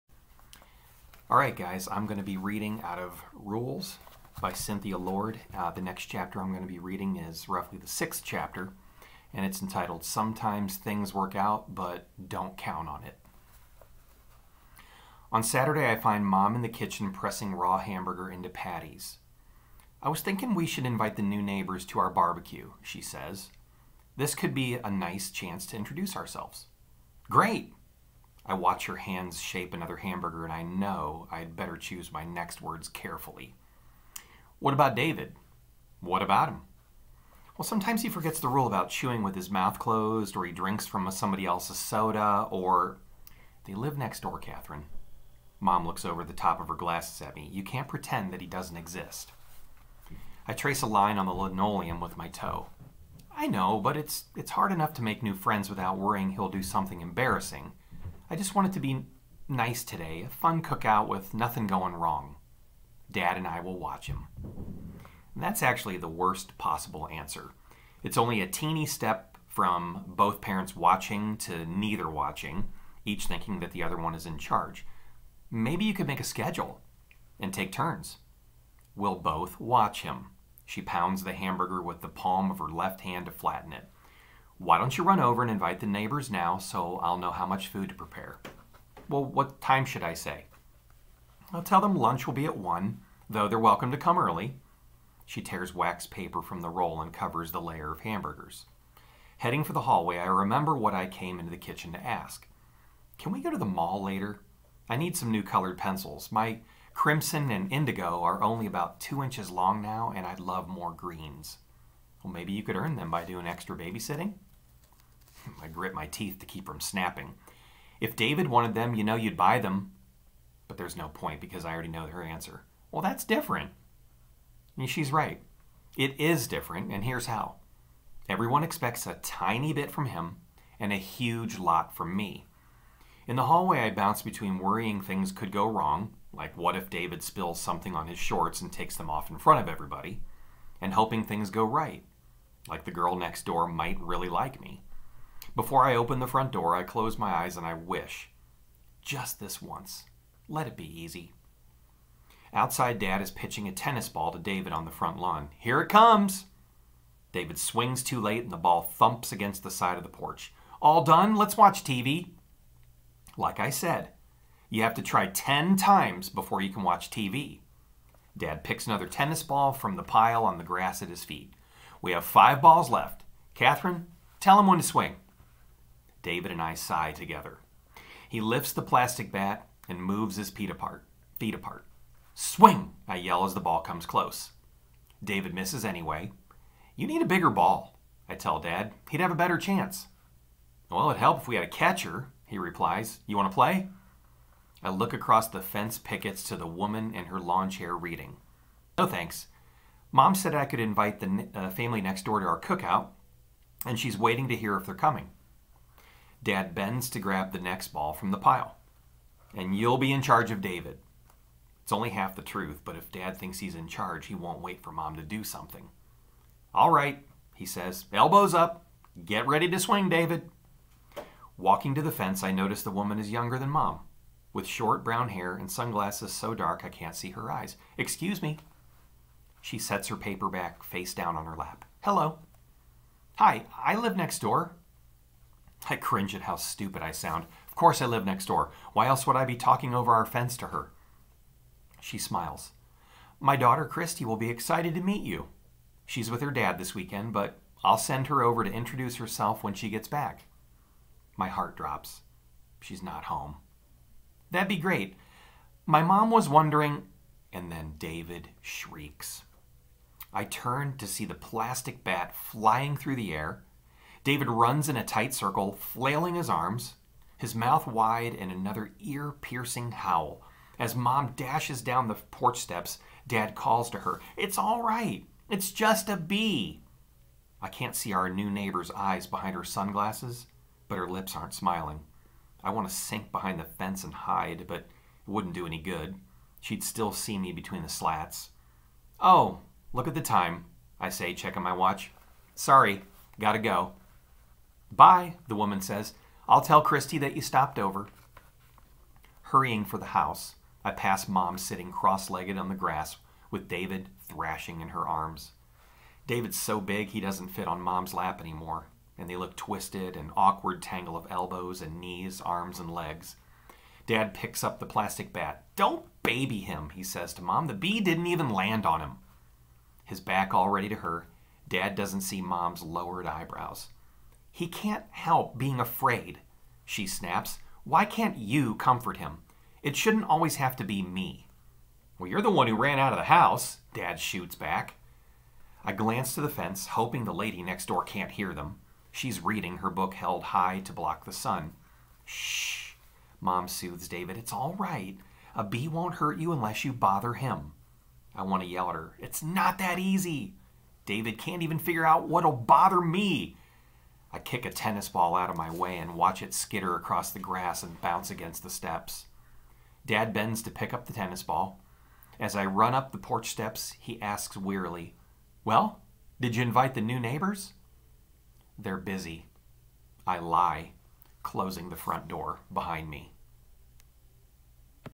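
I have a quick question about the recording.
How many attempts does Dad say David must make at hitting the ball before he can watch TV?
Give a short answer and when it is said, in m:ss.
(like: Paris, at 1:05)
10, at 2:45.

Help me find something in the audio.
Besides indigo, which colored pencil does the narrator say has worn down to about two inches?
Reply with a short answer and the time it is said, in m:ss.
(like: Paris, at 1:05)
crimson, at 1:46.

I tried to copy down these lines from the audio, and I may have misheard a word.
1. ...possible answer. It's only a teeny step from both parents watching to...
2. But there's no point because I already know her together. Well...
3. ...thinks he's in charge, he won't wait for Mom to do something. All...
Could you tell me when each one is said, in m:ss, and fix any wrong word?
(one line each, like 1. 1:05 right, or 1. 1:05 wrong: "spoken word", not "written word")
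1. 1:06 right
2. 2:00 wrong: "answer", not "together"
3. 3:33 right.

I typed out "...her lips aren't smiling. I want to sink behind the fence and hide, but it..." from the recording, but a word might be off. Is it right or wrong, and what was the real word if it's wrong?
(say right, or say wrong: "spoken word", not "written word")
right.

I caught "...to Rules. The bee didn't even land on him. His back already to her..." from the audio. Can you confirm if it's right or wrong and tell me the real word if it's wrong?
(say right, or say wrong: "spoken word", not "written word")
wrong: "Mom", not "Rules".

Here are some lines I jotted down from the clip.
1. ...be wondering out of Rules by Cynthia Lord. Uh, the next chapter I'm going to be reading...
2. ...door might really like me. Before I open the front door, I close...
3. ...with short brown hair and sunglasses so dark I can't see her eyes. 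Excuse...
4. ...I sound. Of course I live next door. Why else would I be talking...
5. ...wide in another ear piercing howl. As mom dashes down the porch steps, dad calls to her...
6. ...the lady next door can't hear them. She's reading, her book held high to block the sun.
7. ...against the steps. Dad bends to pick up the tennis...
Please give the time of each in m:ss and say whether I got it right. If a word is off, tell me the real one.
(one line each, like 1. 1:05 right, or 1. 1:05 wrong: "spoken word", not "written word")
1. 0:02 wrong: "reading", not "wondering"
2. 2:23 right
3. 3:44 right
4. 3:57 right
5. 4:27 right
6. 5:37 right
7. 5:58 right.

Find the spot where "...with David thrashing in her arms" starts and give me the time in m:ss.
5:03.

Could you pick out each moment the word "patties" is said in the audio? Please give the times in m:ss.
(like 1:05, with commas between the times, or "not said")
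0:18.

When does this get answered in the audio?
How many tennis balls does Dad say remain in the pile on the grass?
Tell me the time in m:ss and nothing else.
2:52.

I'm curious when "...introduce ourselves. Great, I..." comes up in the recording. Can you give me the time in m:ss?
0:25.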